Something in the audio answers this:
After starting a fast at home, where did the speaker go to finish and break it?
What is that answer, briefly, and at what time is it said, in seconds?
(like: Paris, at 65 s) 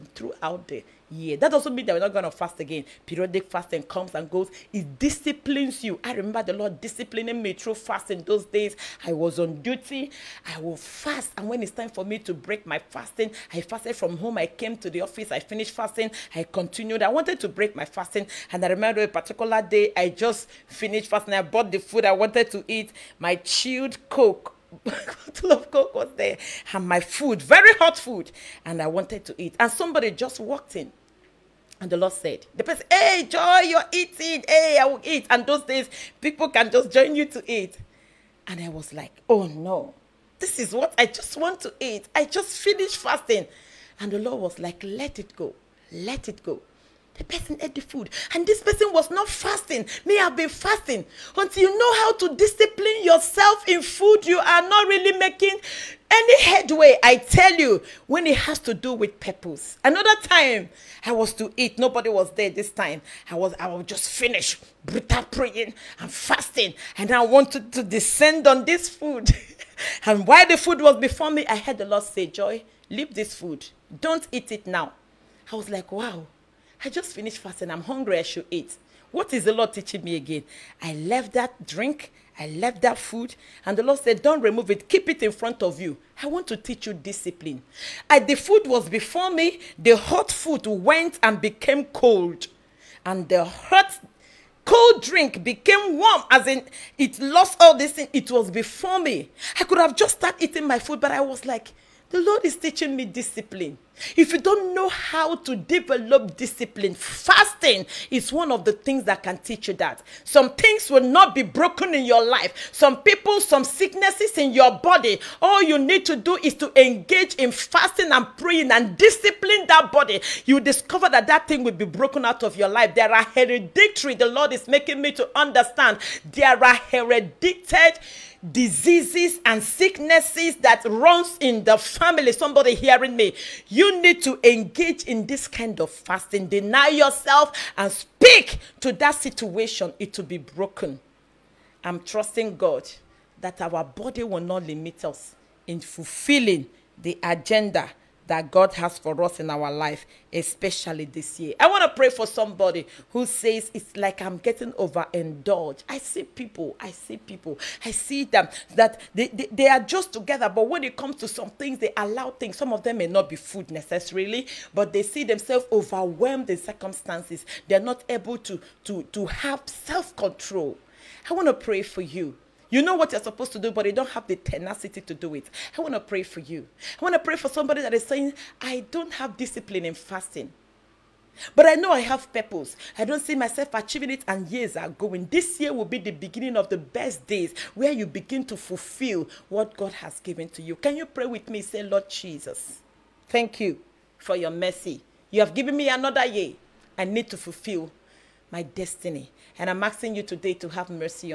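office, at 15 s.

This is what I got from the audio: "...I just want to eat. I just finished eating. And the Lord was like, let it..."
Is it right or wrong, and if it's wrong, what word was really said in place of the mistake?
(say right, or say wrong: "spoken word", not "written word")
wrong: "fasting", not "eating".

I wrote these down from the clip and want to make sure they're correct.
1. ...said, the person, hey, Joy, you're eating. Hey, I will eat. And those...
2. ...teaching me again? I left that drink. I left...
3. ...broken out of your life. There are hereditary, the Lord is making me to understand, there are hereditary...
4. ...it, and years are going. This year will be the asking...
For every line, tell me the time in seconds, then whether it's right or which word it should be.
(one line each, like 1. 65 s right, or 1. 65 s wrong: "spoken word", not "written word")
1. 32 s right
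2. 79 s right
3. 121 s right
4. 184 s wrong: "beginning", not "asking".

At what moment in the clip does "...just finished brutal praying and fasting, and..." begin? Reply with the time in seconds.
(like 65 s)
63 s.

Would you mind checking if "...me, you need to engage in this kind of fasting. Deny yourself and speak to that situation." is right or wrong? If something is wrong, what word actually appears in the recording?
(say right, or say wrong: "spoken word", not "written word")
right.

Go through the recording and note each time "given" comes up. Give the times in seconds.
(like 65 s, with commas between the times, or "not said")
190 s, 195 s.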